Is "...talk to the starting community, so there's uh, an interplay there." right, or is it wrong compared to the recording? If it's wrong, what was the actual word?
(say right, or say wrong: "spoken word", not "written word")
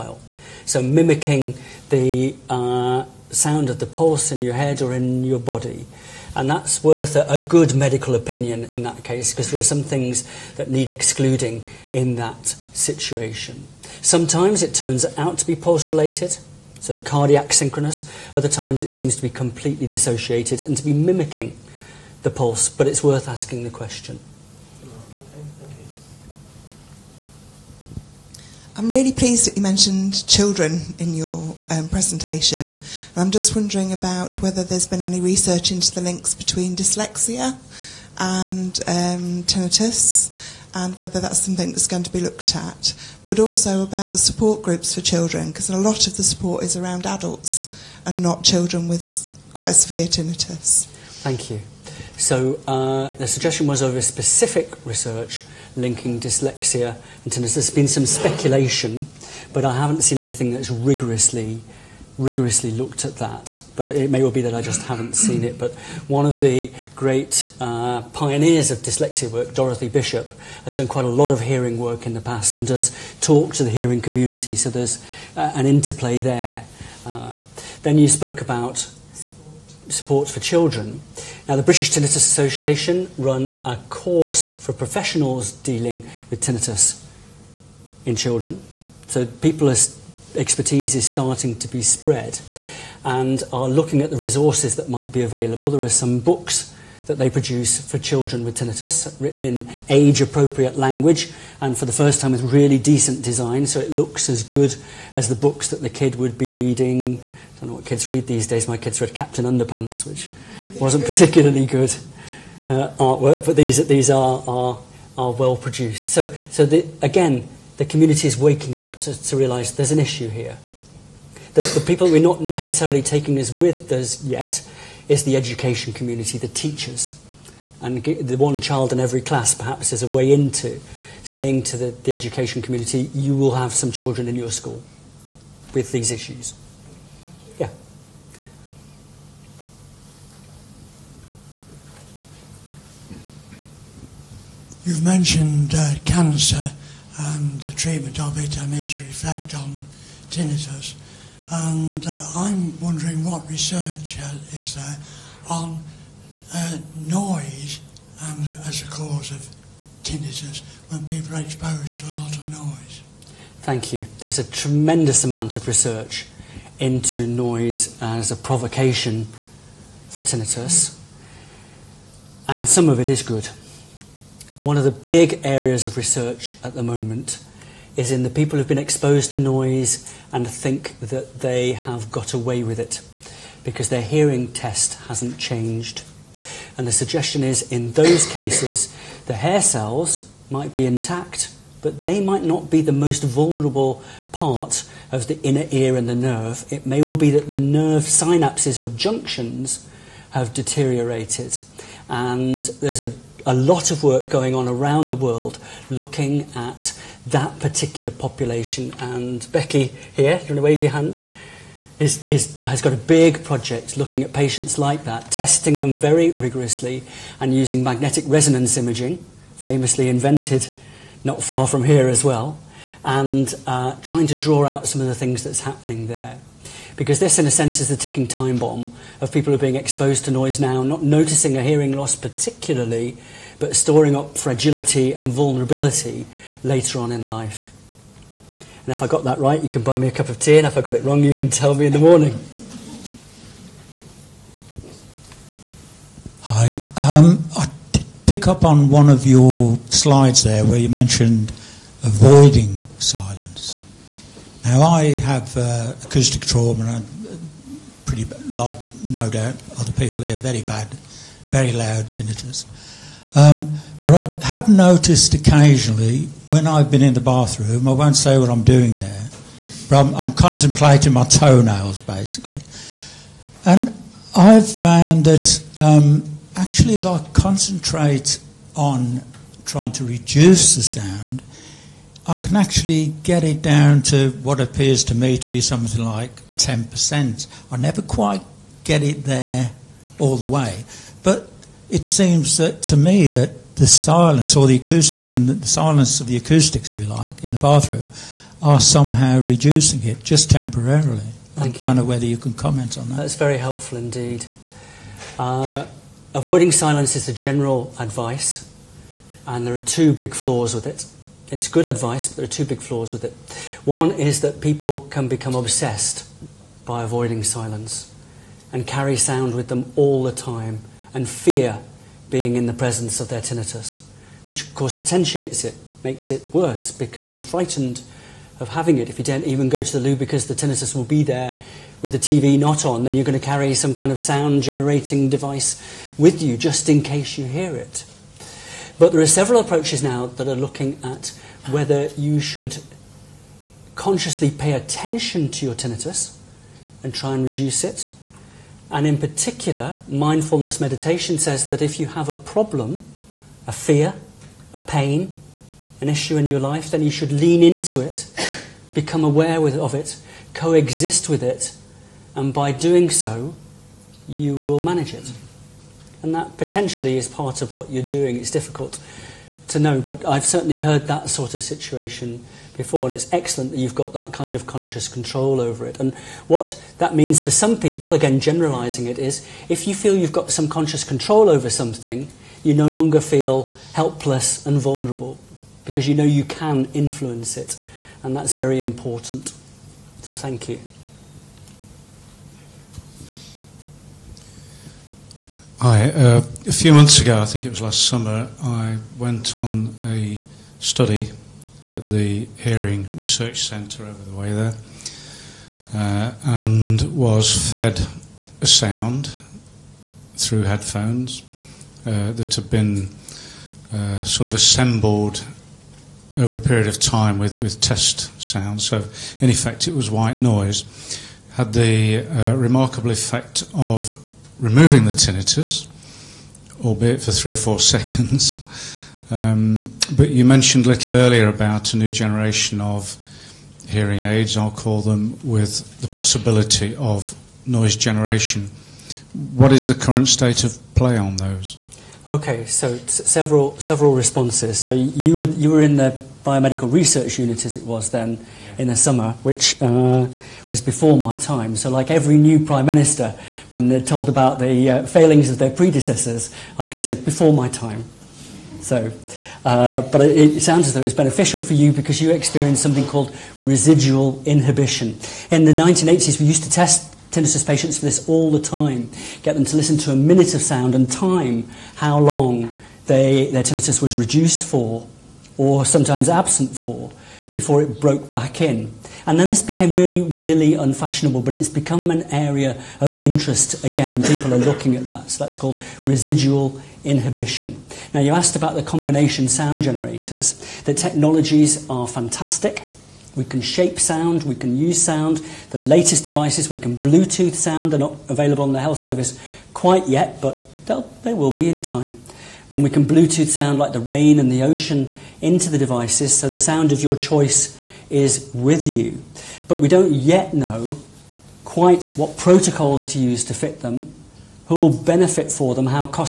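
wrong: "hearing", not "starting".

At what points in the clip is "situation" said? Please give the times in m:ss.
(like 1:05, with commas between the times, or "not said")
0:12, 6:11.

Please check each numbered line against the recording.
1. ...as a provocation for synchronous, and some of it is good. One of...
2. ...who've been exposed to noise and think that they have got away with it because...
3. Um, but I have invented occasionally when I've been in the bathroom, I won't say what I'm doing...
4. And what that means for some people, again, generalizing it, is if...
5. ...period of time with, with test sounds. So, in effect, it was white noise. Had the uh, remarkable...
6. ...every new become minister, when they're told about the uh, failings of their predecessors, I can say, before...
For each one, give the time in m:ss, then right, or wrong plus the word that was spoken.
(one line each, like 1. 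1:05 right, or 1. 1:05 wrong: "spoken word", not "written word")
1. 2:48 wrong: "tinnitus", not "synchronous"
2. 2:58 right
3. 4:23 wrong: "noticed", not "invented"
4. 6:15 right
5. 6:56 right
6. 7:32 wrong: "prime", not "become".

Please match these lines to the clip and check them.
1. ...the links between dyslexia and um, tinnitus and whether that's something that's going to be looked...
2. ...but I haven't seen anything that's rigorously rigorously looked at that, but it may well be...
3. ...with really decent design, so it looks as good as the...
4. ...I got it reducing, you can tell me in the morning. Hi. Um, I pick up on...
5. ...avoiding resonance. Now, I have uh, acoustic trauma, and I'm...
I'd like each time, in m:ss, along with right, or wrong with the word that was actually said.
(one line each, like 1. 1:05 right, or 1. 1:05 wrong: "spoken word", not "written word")
1. 0:35 right
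2. 0:59 right
3. 1:42 right
4. 4:00 wrong: "wrong", not "reducing"
5. 4:12 wrong: "silence", not "resonance".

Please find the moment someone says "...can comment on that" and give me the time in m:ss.
5:02.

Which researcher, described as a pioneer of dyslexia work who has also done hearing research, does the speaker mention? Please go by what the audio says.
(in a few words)
Dorothy Bishop.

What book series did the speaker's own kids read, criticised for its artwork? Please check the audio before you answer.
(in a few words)
Captain Underpants.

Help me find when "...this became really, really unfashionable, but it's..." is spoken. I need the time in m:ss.
7:59.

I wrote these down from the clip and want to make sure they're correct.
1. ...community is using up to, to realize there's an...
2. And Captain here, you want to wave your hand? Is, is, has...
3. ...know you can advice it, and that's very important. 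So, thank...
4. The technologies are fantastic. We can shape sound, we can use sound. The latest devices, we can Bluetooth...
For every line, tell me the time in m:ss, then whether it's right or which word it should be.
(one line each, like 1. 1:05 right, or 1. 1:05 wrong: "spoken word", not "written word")
1. 1:57 wrong: "waking", not "using"
2. 3:28 wrong: "Becky", not "Captain"
3. 6:26 wrong: "influence", not "advice"
4. 8:10 right.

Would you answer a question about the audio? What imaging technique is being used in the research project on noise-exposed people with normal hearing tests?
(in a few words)
magnetic resonance imaging.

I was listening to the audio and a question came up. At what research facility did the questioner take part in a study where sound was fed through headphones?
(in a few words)
Hearing Research Centre.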